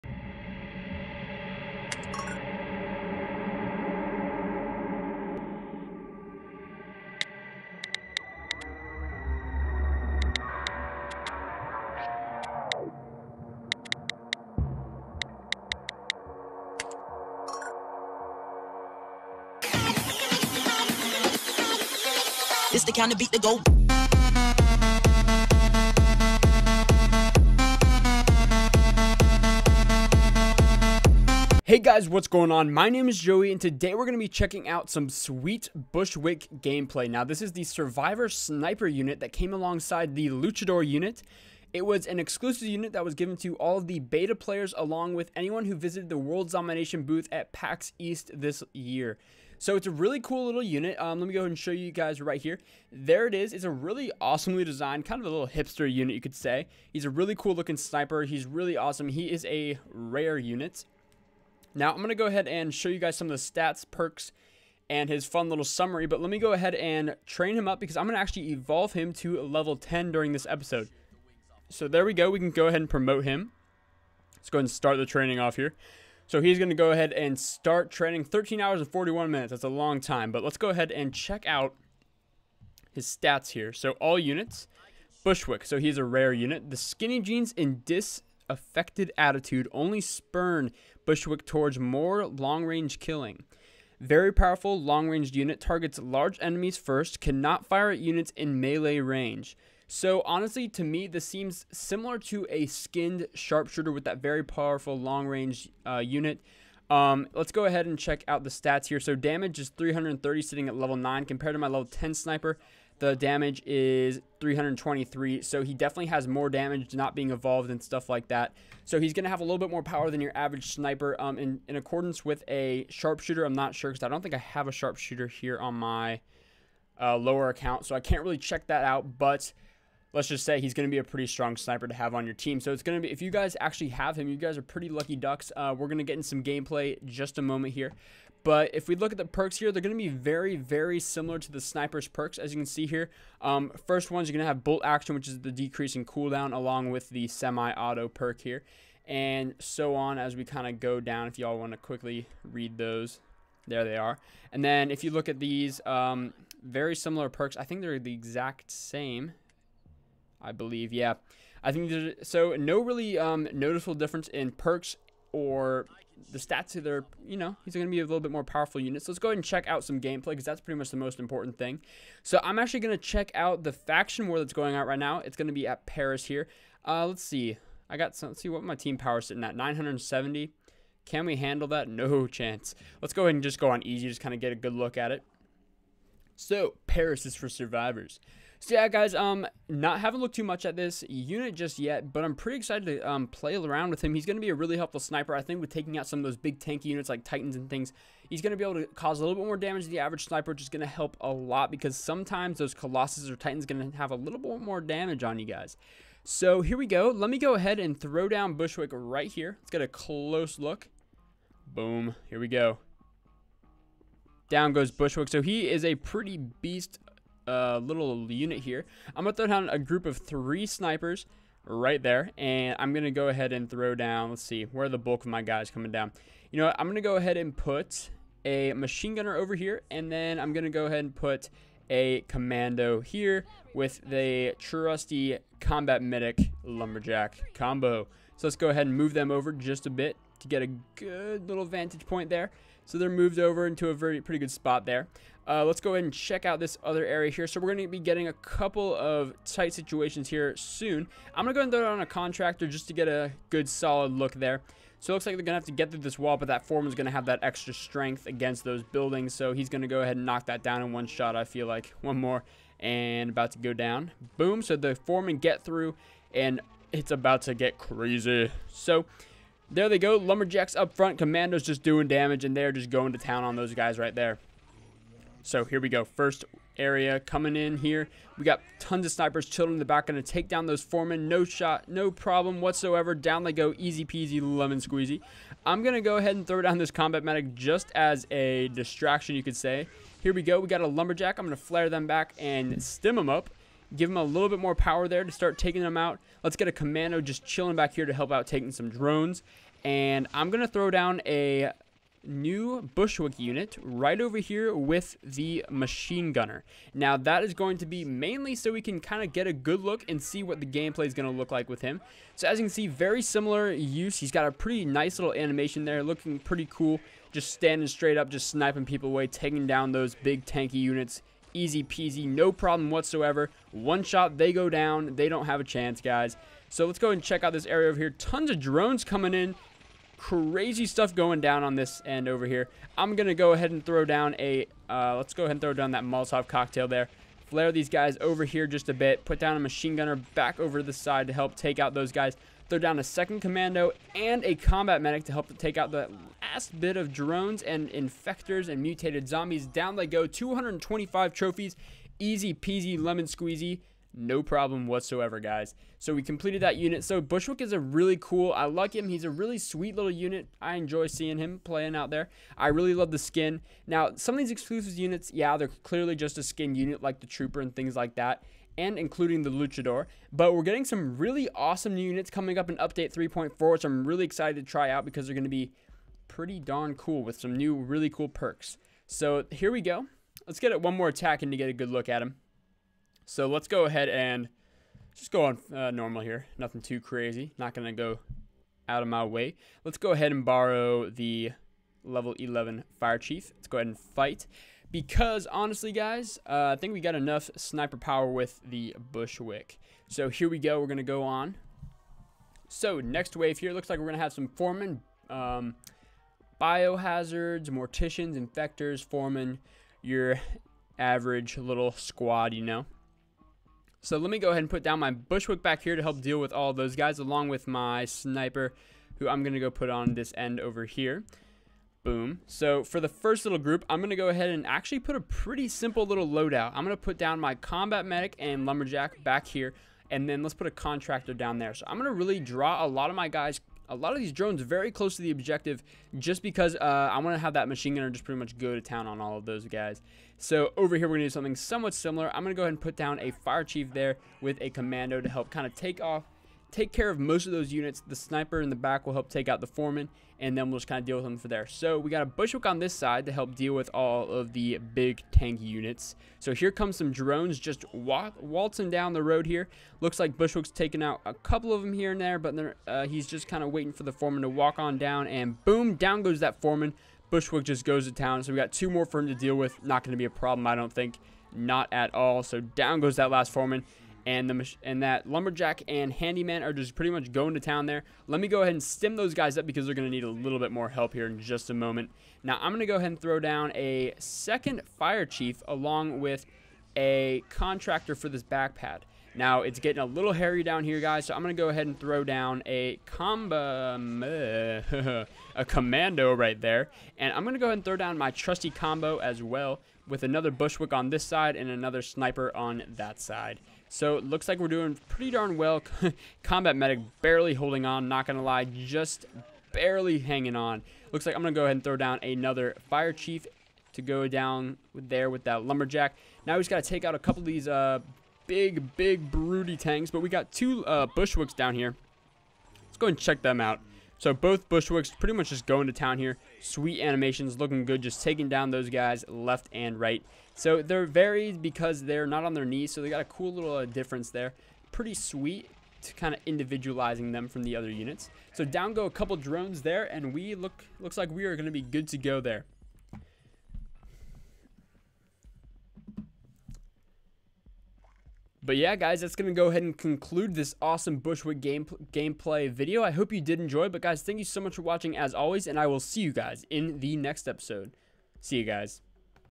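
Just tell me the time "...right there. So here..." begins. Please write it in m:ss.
4:33.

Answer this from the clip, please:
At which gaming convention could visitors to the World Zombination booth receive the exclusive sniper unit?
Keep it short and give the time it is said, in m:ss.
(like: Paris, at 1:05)
PAX East, at 0:47.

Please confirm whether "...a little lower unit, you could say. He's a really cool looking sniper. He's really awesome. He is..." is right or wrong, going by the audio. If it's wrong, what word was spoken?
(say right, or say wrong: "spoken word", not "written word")
wrong: "hipster", not "lower".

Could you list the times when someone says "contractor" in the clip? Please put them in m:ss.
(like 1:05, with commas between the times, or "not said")
4:12, 7:10, 8:07.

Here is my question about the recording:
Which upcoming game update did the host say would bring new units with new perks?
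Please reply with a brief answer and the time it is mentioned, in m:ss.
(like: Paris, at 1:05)
Update 3.4, at 6:12.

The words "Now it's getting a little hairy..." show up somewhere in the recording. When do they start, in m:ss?
8:09.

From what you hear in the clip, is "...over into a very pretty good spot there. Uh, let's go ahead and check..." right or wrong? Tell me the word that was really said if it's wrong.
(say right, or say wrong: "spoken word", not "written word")
right.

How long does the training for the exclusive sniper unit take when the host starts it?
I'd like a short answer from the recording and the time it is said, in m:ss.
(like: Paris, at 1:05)
13 hours and 41 minutes, at 1:18.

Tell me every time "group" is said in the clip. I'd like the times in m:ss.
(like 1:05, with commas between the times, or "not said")
3:39, 7:03.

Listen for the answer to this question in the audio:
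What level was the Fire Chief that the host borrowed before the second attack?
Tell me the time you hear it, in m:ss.
6:32.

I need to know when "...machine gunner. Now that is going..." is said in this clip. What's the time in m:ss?
5:05.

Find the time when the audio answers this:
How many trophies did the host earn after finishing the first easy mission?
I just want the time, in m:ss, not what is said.
5:50.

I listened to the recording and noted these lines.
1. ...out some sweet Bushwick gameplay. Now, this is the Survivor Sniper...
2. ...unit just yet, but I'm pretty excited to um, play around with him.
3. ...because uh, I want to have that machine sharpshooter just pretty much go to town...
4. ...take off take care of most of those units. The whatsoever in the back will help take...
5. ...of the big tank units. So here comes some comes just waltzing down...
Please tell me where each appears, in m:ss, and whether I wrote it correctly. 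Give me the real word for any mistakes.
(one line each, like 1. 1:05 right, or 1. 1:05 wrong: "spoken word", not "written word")
1. 0:34 right
2. 3:11 right
3. 7:16 wrong: "gunner", not "sharpshooter"
4. 7:25 wrong: "sniper", not "whatsoever"
5. 7:34 wrong: "drones", not "comes".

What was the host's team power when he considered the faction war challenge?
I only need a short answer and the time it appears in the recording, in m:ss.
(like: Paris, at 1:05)
970, at 2:59.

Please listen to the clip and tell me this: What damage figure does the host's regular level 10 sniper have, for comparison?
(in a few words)
323.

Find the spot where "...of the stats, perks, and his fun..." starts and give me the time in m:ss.
1:03.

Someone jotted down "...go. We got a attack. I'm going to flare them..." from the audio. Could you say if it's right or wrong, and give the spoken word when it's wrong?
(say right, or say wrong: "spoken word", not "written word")
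wrong: "lumberjack", not "attack".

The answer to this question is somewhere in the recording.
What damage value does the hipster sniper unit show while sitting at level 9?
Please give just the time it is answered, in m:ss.
1:49.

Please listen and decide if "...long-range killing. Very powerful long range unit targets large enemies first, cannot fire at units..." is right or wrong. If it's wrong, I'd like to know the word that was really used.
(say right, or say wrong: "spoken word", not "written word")
right.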